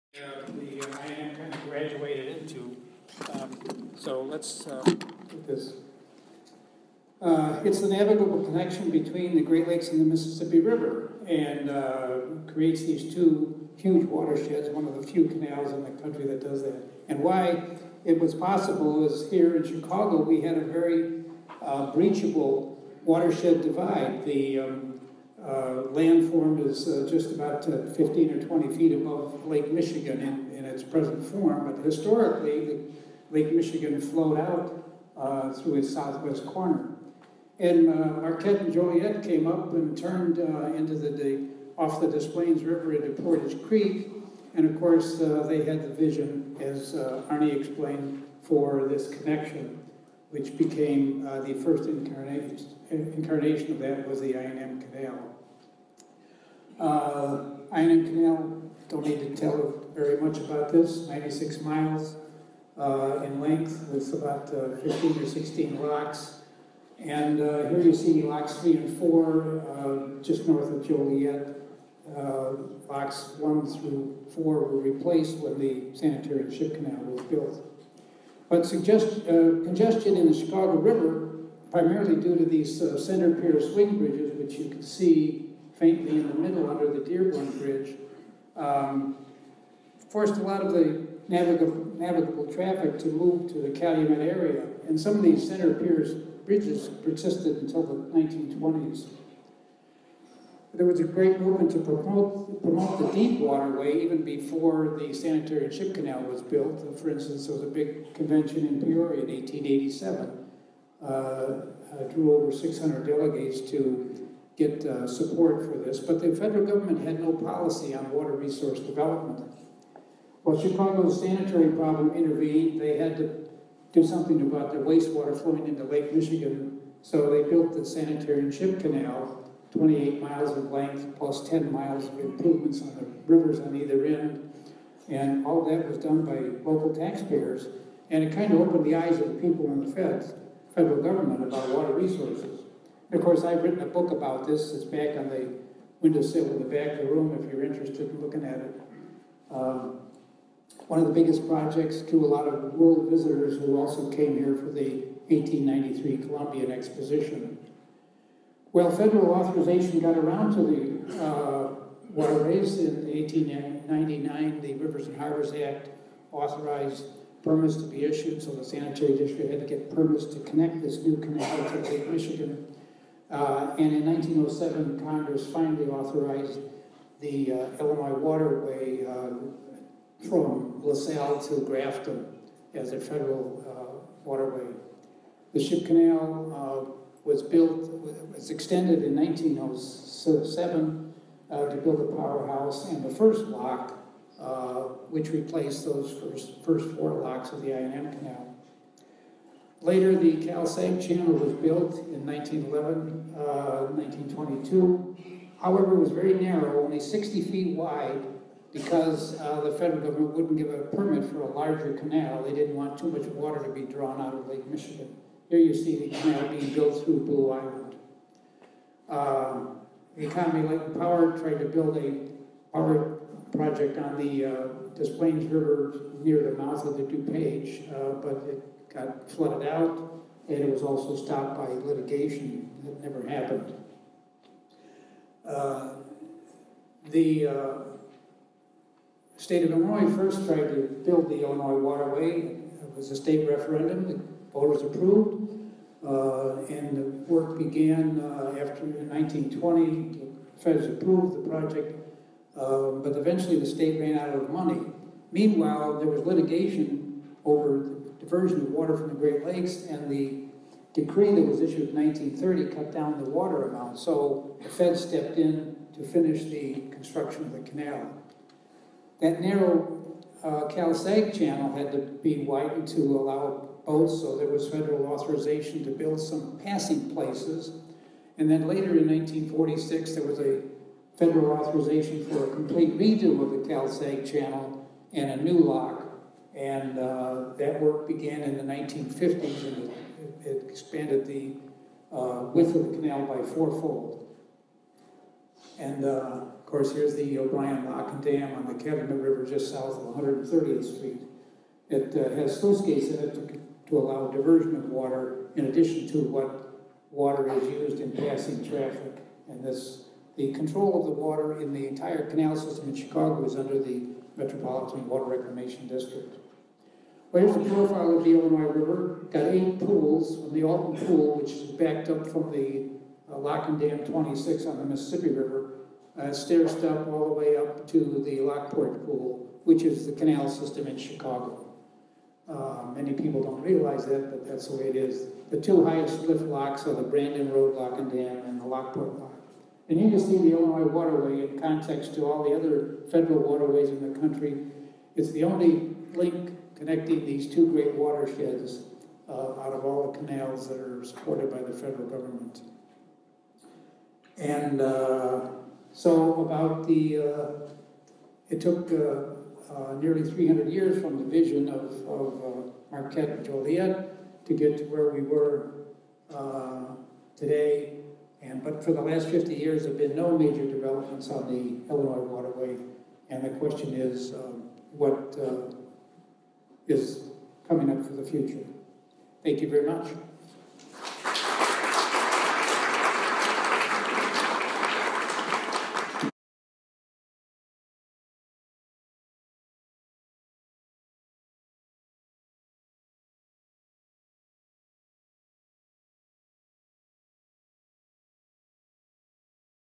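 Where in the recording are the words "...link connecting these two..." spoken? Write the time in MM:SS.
05:46.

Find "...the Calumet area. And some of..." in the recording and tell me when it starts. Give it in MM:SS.
01:33.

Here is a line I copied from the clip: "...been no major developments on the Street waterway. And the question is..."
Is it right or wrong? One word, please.
wrong.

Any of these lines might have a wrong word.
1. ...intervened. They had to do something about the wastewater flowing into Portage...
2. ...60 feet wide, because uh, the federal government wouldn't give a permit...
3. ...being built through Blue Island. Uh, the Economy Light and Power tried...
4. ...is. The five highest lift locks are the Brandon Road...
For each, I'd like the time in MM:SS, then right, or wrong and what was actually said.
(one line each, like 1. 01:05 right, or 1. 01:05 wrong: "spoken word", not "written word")
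1. 02:02 wrong: "Lake", not "Portage"
2. 03:26 right
3. 03:36 right
4. 05:34 wrong: "two", not "five".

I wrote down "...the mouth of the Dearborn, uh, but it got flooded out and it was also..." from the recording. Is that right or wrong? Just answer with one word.
wrong.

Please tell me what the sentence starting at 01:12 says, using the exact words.
locks 1 through 4 were replaced when the sanitary ship canal was built.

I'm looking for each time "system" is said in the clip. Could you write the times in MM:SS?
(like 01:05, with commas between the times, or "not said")
05:12, 05:30.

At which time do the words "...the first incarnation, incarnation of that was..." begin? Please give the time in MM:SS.
00:51.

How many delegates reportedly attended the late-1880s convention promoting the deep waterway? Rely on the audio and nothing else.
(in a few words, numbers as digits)
over 600.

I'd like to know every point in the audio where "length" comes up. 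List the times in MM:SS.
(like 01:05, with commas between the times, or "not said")
01:03, 02:10.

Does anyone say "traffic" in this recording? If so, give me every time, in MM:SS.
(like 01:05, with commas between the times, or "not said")
01:32, 05:08.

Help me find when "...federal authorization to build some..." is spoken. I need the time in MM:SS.
04:34.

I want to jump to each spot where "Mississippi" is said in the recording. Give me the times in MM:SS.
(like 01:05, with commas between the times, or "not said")
00:10, 05:24.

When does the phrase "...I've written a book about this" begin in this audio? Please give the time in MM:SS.
02:23.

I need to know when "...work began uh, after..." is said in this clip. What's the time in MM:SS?
04:07.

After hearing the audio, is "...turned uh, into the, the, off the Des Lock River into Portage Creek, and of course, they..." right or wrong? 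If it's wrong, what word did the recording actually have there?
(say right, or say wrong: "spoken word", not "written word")
wrong: "Plaines", not "Lock".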